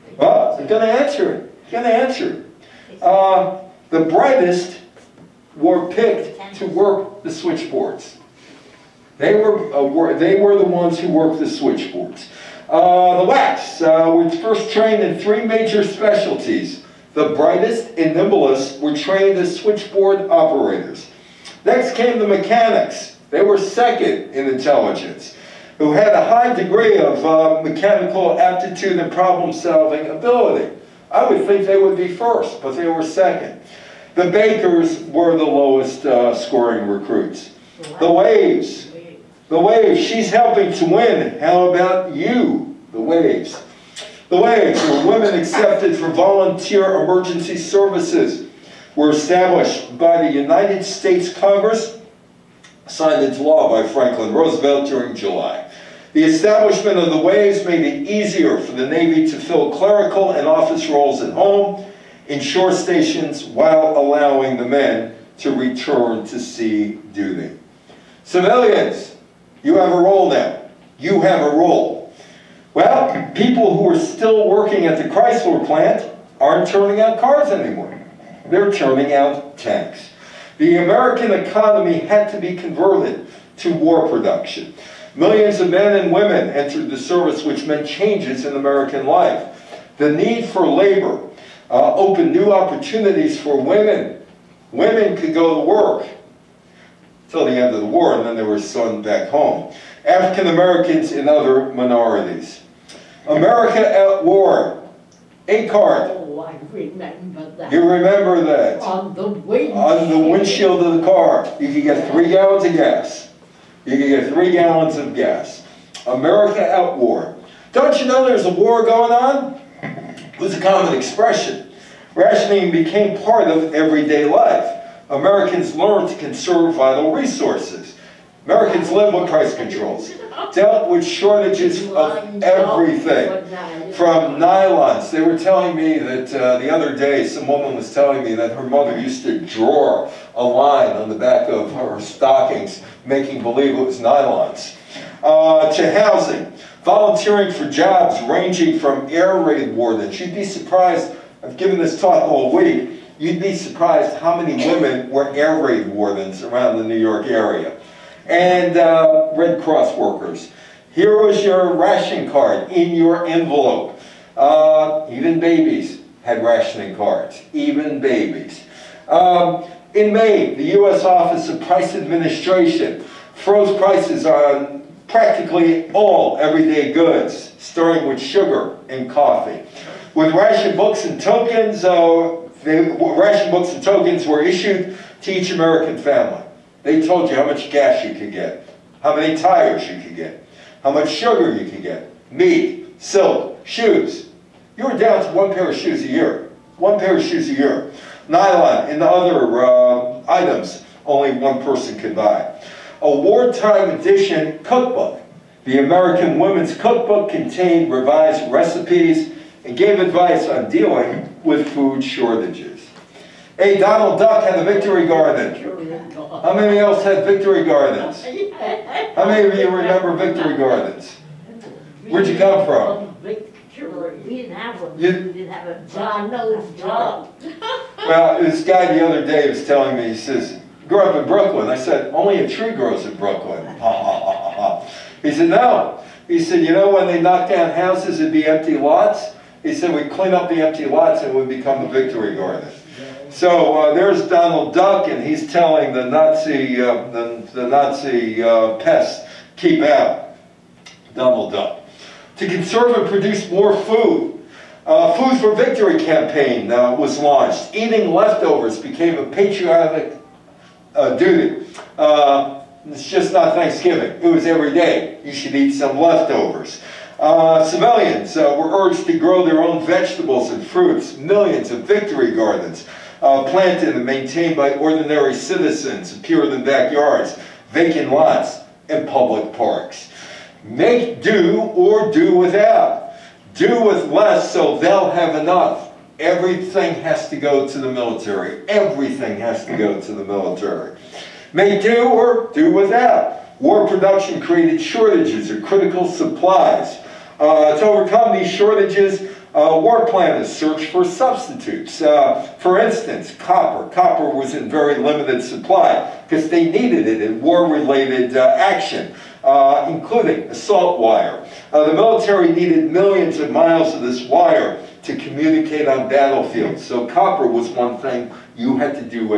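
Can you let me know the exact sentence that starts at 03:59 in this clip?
He said, we clean up the empty lots and we become a victory garden.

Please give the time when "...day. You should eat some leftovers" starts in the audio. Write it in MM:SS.
04:24.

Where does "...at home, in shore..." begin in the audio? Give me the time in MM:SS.
01:01.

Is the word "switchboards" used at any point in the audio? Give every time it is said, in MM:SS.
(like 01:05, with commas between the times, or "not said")
00:07, 00:11, 00:19.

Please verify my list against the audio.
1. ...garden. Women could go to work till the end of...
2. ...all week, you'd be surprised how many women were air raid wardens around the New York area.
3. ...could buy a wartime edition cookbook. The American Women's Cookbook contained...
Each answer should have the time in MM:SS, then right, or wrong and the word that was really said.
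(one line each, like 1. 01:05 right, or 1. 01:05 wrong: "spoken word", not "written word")
1. 01:33 wrong: "women", not "garden"
2. 02:32 right
3. 03:21 right.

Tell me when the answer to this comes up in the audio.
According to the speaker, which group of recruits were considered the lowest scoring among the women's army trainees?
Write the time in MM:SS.
00:34.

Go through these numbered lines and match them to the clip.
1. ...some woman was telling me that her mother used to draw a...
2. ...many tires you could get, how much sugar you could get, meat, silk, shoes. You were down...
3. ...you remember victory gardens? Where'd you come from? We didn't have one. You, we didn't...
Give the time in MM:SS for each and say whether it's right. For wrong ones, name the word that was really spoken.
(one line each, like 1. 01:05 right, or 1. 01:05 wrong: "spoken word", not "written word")
1. 02:17 right
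2. 03:09 right
3. 03:39 right.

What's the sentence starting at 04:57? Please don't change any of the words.
Uh, to overcome these shortages, uh, war planners searched for substitutes.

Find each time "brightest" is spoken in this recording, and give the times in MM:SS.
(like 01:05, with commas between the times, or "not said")
00:04, 00:17.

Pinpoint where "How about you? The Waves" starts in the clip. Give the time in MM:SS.
00:41.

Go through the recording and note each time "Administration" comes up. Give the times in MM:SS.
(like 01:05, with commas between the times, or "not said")
02:51.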